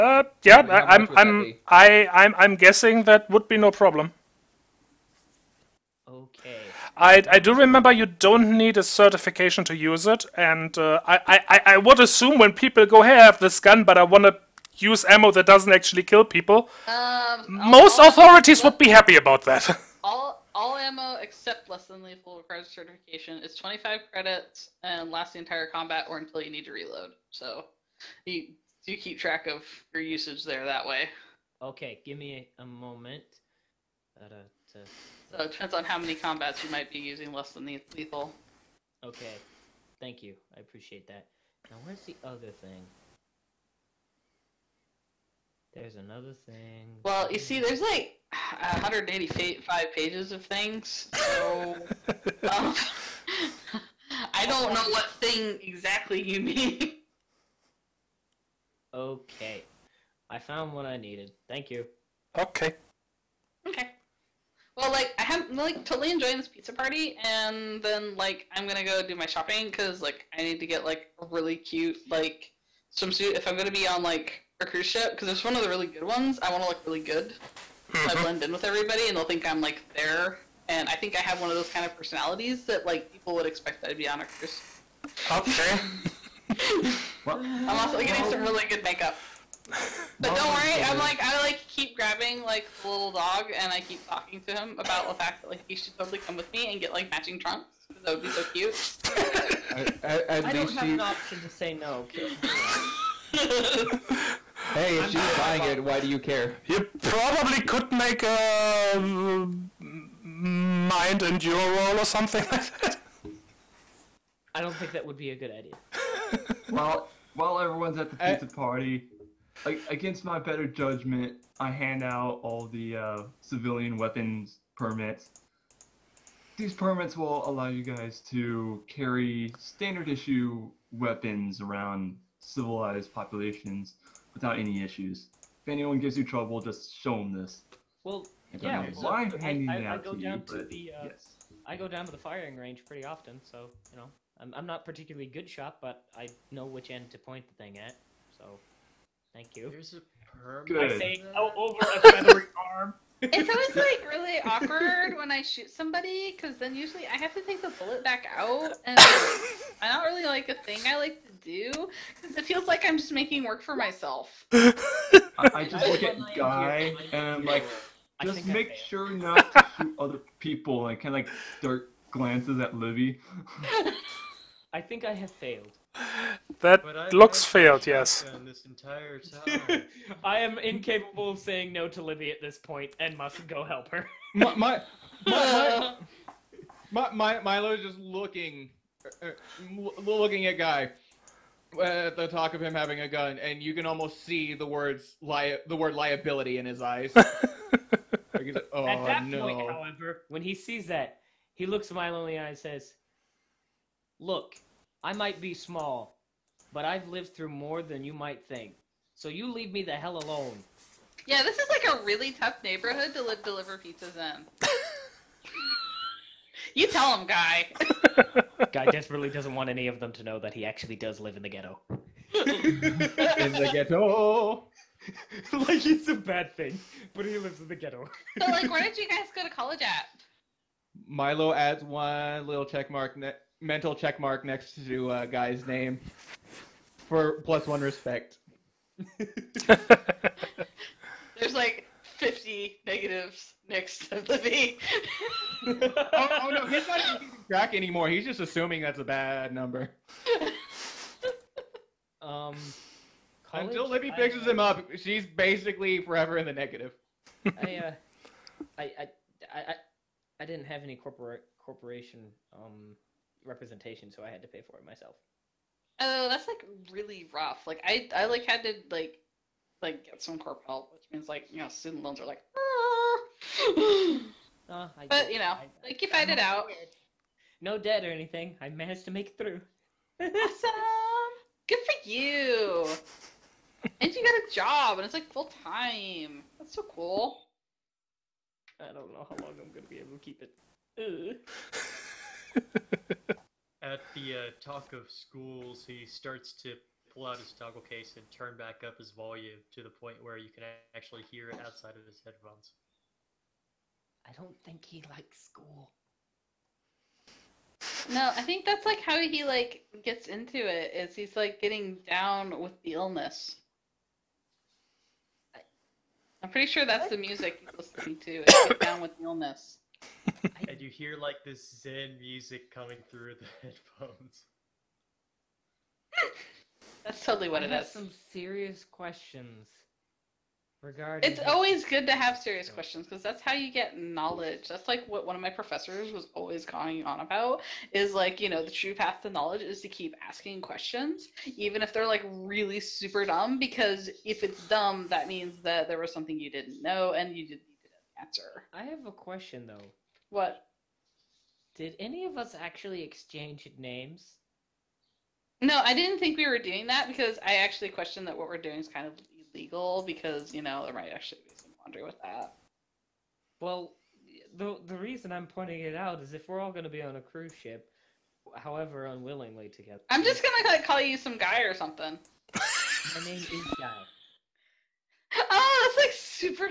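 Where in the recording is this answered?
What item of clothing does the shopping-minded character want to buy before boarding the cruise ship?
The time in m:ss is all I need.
1:12.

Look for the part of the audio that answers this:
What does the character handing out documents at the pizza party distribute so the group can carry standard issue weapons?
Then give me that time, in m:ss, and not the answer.
2:03.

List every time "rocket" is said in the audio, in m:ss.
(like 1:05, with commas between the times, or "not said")
not said.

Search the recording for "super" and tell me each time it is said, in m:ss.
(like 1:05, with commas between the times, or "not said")
5:42, 6:16.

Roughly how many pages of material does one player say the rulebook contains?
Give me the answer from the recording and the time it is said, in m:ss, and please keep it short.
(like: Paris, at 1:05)
185, at 0:48.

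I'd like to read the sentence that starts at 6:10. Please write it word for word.
I'm just going to call you some guy or something.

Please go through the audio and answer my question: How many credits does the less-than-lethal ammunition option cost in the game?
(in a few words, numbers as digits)
25.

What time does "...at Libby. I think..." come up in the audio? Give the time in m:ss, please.
2:52.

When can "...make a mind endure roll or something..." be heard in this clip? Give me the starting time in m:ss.
1:47.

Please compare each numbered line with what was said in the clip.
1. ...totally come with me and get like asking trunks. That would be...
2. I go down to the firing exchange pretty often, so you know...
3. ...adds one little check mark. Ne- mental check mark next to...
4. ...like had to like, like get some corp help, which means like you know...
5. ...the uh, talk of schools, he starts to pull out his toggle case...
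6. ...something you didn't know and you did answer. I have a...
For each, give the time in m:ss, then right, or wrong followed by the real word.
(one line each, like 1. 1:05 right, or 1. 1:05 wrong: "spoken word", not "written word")
1. 1:35 wrong: "matching", not "asking"
2. 2:21 wrong: "range", not "exchange"
3. 3:51 right
4. 4:28 right
5. 4:54 right
6. 5:46 right.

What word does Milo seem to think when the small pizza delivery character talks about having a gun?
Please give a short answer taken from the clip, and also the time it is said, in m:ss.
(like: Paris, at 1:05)
liability, at 3:15.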